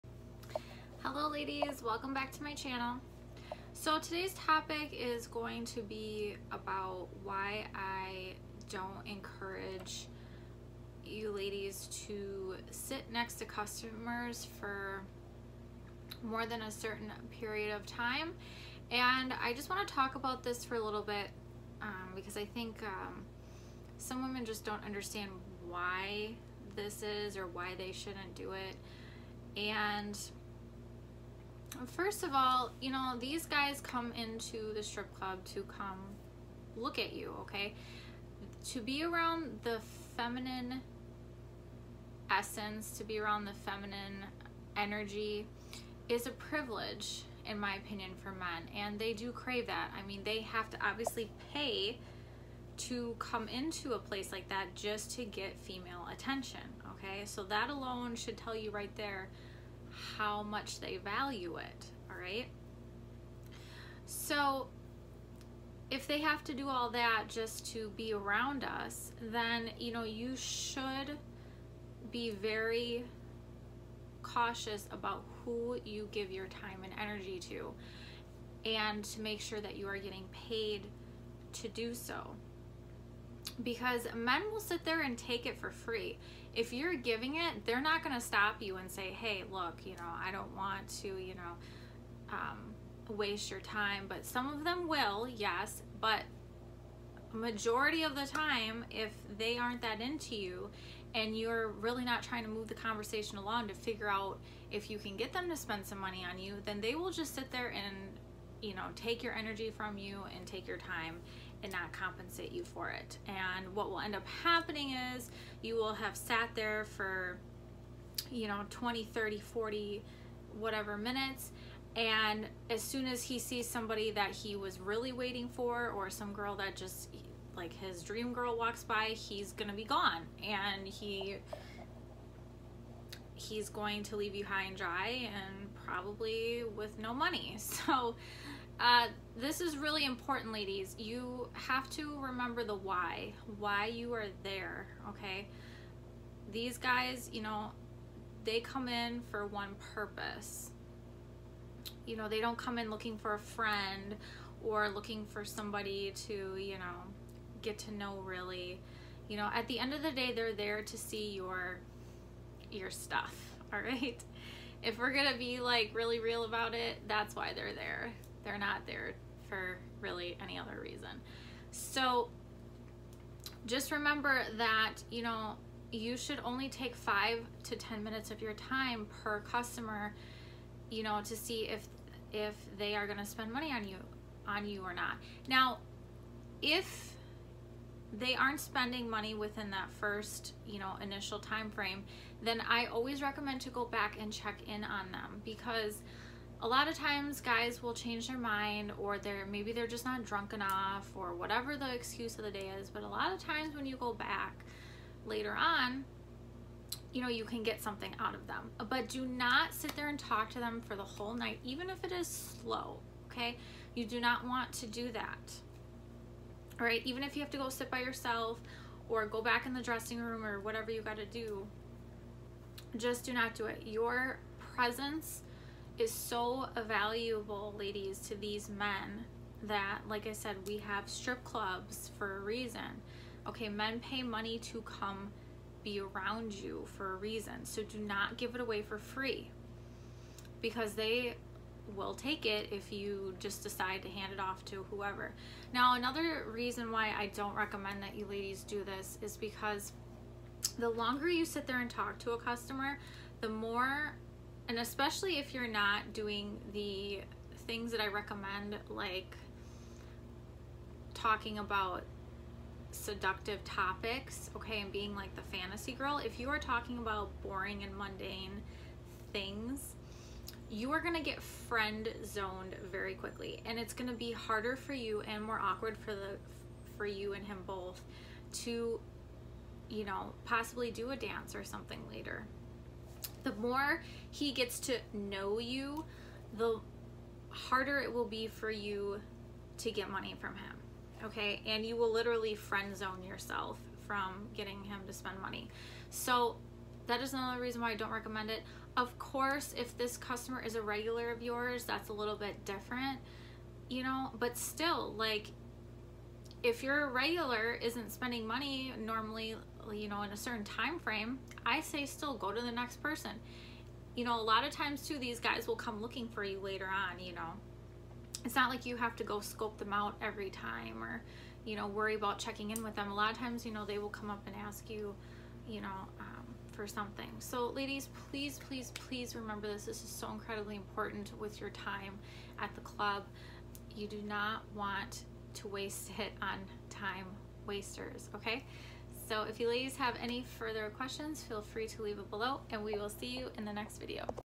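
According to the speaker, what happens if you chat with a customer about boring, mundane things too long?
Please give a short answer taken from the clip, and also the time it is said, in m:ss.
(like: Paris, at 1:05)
Friend zoned, at 4:31.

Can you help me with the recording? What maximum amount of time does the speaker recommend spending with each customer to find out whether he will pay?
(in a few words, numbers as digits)
5 to 10 minutes.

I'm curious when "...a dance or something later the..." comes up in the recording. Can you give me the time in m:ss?
4:41.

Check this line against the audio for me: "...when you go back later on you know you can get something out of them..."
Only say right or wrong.
right.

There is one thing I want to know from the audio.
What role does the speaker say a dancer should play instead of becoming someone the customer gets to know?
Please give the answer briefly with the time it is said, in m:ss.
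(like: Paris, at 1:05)
The fantasy girl, at 4:25.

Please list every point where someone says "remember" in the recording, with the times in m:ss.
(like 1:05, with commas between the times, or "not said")
2:22, 2:53, 5:29.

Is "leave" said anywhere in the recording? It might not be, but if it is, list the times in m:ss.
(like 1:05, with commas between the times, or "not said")
2:14, 5:42.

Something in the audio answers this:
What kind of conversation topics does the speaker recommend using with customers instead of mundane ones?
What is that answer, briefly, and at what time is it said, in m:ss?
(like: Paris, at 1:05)
Seductive topics, at 4:22.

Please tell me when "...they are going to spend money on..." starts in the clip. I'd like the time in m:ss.
3:02.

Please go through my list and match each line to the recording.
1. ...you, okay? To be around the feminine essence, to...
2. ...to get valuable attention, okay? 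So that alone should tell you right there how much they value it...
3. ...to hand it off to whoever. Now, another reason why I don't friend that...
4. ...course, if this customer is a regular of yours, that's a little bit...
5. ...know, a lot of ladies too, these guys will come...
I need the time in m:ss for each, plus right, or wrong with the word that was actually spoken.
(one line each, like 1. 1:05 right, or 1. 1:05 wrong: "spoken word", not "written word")
1. 0:37 right
2. 0:55 wrong: "female", not "valuable"
3. 4:04 wrong: "recommend", not "friend"
4. 4:59 right
5. 5:14 wrong: "times", not "ladies".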